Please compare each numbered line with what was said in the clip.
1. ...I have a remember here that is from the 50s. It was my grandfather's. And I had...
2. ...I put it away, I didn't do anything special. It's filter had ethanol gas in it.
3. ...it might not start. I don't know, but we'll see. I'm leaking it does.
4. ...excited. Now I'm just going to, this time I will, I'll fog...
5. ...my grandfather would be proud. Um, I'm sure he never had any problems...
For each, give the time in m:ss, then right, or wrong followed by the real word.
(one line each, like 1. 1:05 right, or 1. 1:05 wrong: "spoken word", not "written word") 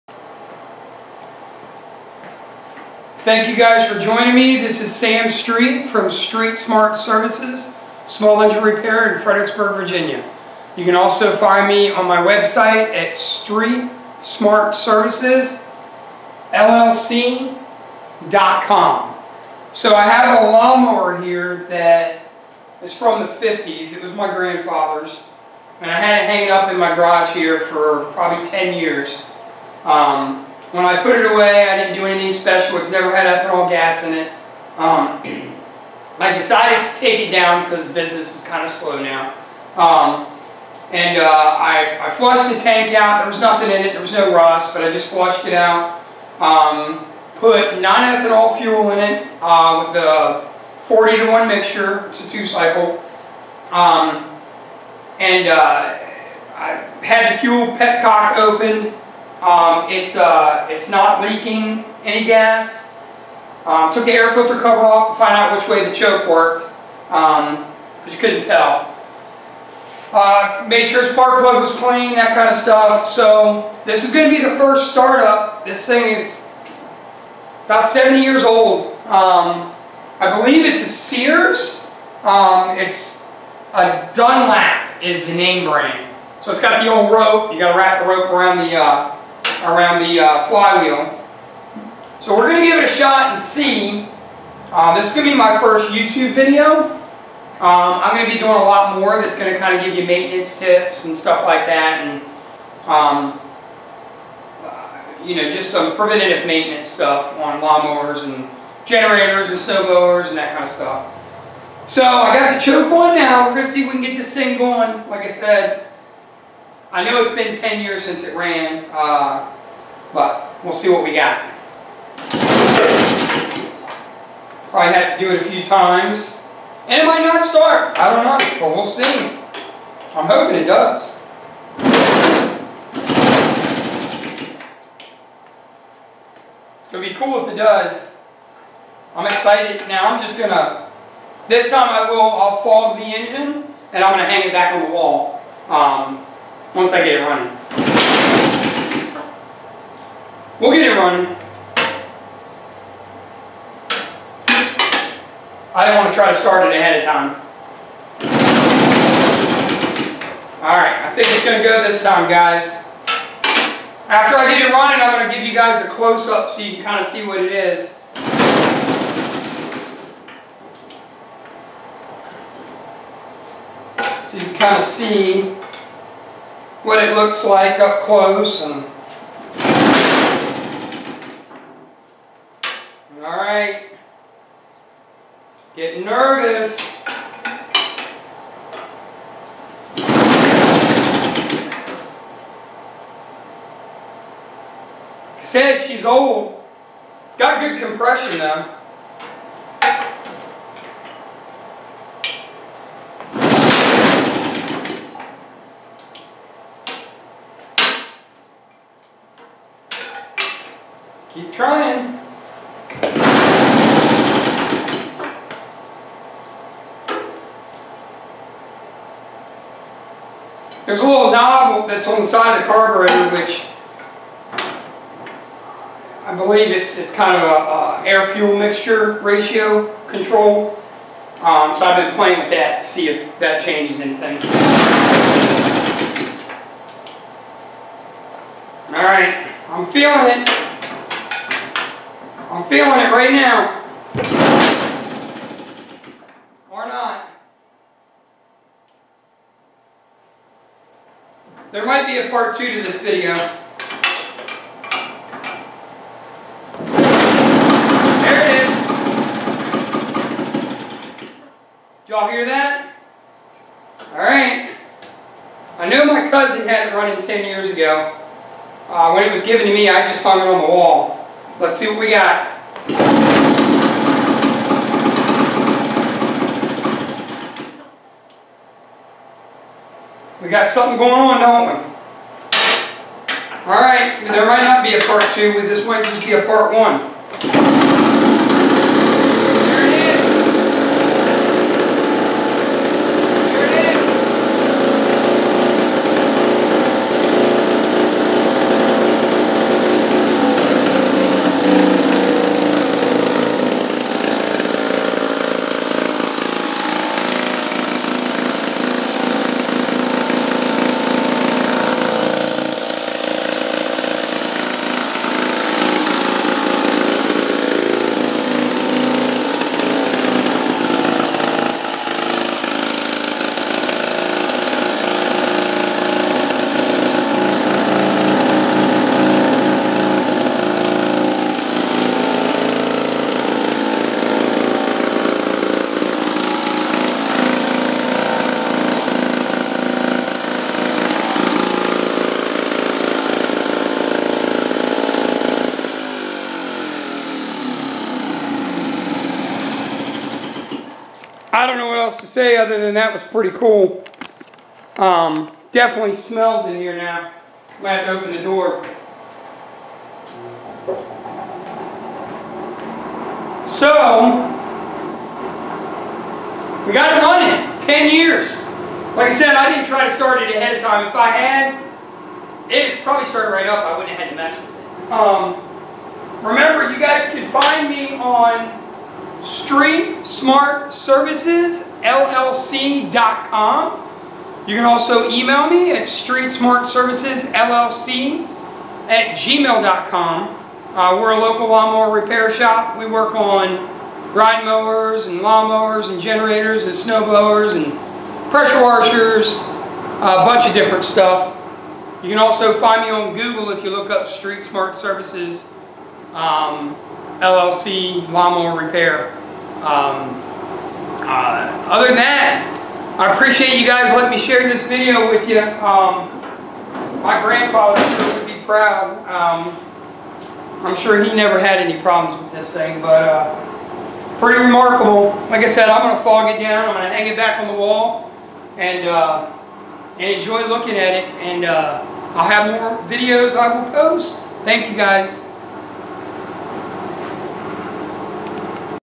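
1. 0:19 wrong: "lawnmower", not "remember"
2. 0:30 wrong: "never", not "filter"
3. 2:07 wrong: "hoping", not "leaking"
4. 2:19 right
5. 6:57 right.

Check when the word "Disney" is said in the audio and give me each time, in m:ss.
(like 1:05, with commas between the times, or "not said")
not said.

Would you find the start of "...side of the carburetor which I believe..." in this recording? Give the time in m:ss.
3:42.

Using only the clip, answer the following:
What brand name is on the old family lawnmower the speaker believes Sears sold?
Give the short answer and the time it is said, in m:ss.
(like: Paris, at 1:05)
Dunlap, at 1:24.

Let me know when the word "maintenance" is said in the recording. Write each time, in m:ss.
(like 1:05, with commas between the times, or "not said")
1:40, 1:46.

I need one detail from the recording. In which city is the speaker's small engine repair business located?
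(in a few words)
Fredericksburg, Virginia.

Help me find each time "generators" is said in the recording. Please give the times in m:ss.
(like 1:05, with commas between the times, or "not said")
1:48, 6:36.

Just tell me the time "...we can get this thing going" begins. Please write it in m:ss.
1:53.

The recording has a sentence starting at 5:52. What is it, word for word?
else to say other than that was pretty cool.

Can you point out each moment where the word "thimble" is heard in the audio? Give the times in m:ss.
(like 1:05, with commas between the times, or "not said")
not said.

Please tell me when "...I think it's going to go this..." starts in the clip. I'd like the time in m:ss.
2:41.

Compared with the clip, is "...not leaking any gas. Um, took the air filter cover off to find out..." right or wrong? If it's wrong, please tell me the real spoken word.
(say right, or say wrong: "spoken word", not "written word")
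right.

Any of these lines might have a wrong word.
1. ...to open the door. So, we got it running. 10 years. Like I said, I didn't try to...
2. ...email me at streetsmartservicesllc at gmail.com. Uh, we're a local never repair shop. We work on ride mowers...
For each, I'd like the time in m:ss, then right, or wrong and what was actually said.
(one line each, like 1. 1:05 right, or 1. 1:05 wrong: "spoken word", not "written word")
1. 5:58 right
2. 6:25 wrong: "lawnmower", not "never".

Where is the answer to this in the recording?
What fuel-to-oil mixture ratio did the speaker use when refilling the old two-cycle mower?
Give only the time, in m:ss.
0:50.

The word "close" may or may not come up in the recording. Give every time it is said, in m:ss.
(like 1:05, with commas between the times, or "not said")
2:45, 2:58.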